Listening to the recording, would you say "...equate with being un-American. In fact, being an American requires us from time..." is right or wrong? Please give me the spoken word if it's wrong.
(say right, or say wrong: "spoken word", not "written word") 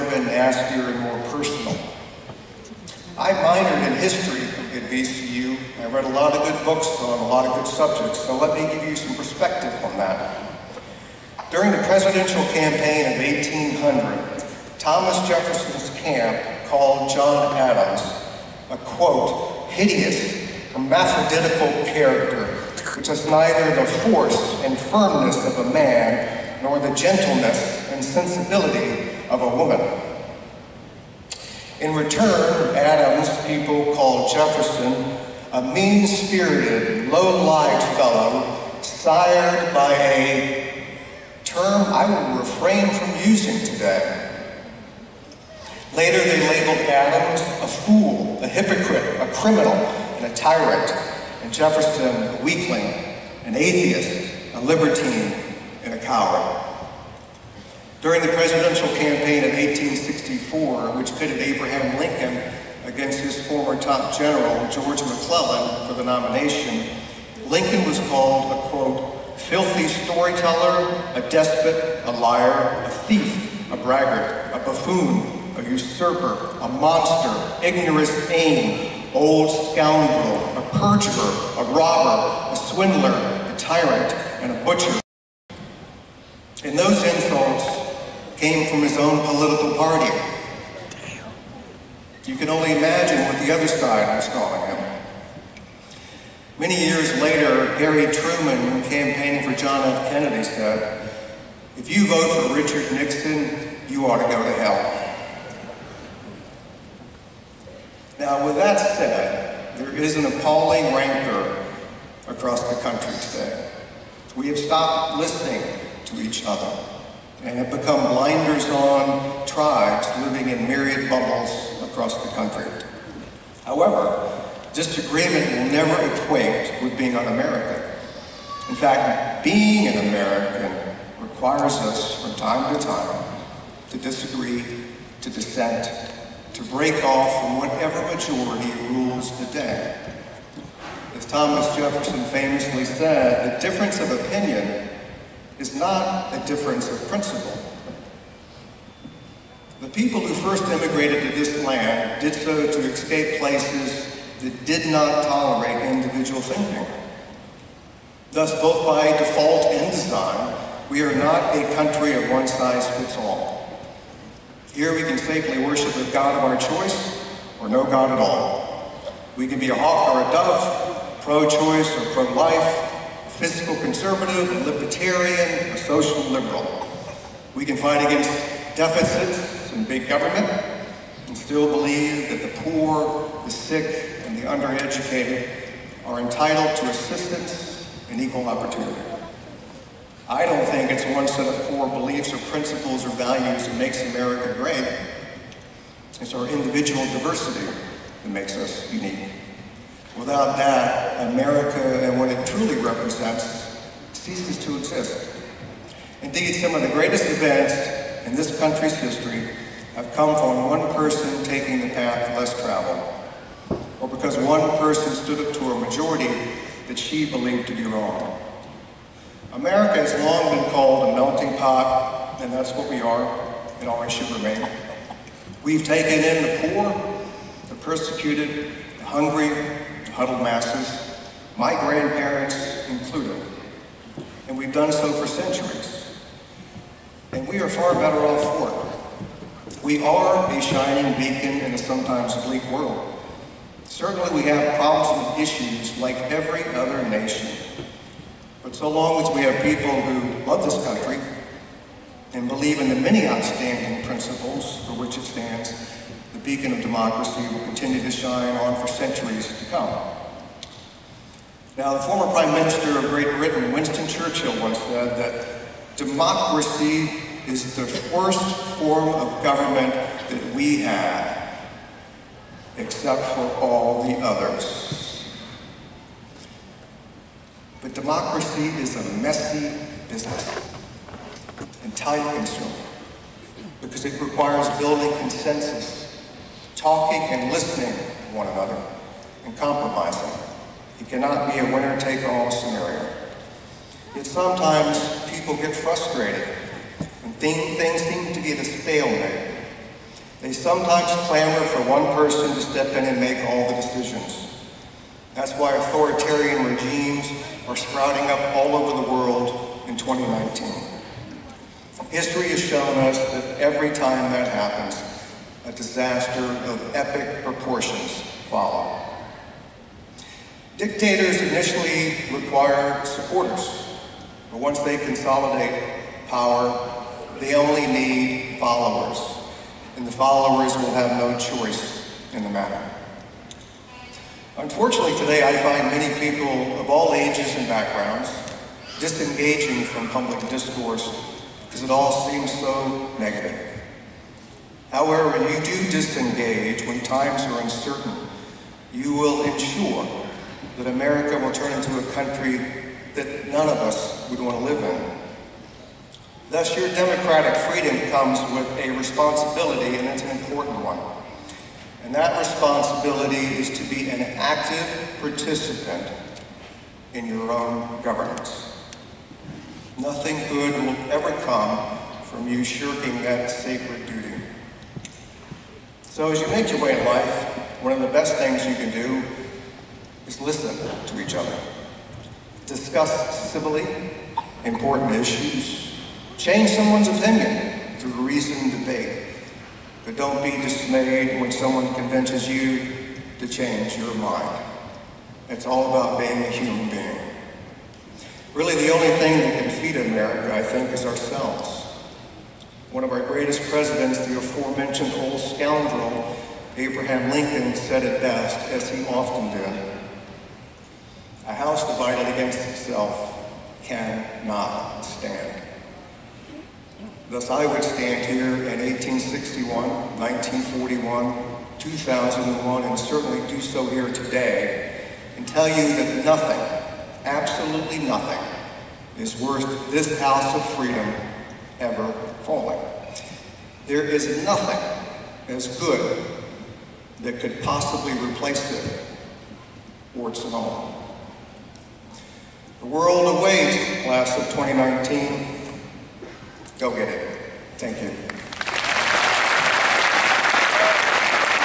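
right.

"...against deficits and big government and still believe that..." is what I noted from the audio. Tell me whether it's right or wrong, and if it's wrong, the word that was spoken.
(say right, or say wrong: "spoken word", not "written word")
right.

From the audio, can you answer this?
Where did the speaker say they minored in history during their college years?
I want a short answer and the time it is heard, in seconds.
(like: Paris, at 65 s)
VCU, at 4 s.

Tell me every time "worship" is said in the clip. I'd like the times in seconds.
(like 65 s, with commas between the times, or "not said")
165 s.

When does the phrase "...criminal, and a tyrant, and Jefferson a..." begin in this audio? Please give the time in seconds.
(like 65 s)
49 s.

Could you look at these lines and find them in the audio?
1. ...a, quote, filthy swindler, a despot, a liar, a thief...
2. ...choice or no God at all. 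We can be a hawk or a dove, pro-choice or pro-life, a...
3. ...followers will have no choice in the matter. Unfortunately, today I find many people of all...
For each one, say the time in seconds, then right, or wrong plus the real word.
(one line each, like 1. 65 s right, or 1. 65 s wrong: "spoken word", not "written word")
1. 68 s wrong: "storyteller", not "swindler"
2. 166 s right
3. 330 s right.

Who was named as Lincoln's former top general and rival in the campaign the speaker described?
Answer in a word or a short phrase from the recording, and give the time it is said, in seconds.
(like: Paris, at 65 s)
George McClellan, at 64 s.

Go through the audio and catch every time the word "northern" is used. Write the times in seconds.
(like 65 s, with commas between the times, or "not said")
not said.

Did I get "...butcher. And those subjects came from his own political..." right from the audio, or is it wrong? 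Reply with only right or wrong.
wrong.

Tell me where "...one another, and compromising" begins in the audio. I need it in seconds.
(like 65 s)
288 s.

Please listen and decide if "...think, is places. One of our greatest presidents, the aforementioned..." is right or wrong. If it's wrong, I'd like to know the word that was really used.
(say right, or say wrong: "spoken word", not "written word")
wrong: "ourselves", not "places".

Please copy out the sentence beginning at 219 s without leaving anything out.
America has long been called a melting pot, and that's what we are, It always should remain.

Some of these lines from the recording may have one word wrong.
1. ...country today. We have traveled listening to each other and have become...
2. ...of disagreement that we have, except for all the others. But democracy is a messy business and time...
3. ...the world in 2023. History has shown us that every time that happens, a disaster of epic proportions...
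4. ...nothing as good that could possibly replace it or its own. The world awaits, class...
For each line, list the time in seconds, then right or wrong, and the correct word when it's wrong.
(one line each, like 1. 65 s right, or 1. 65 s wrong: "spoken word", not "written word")
1. 112 s wrong: "stopped", not "traveled"
2. 269 s wrong: "government", not "disagreement"
3. 309 s wrong: "2019", not "2023"
4. 434 s right.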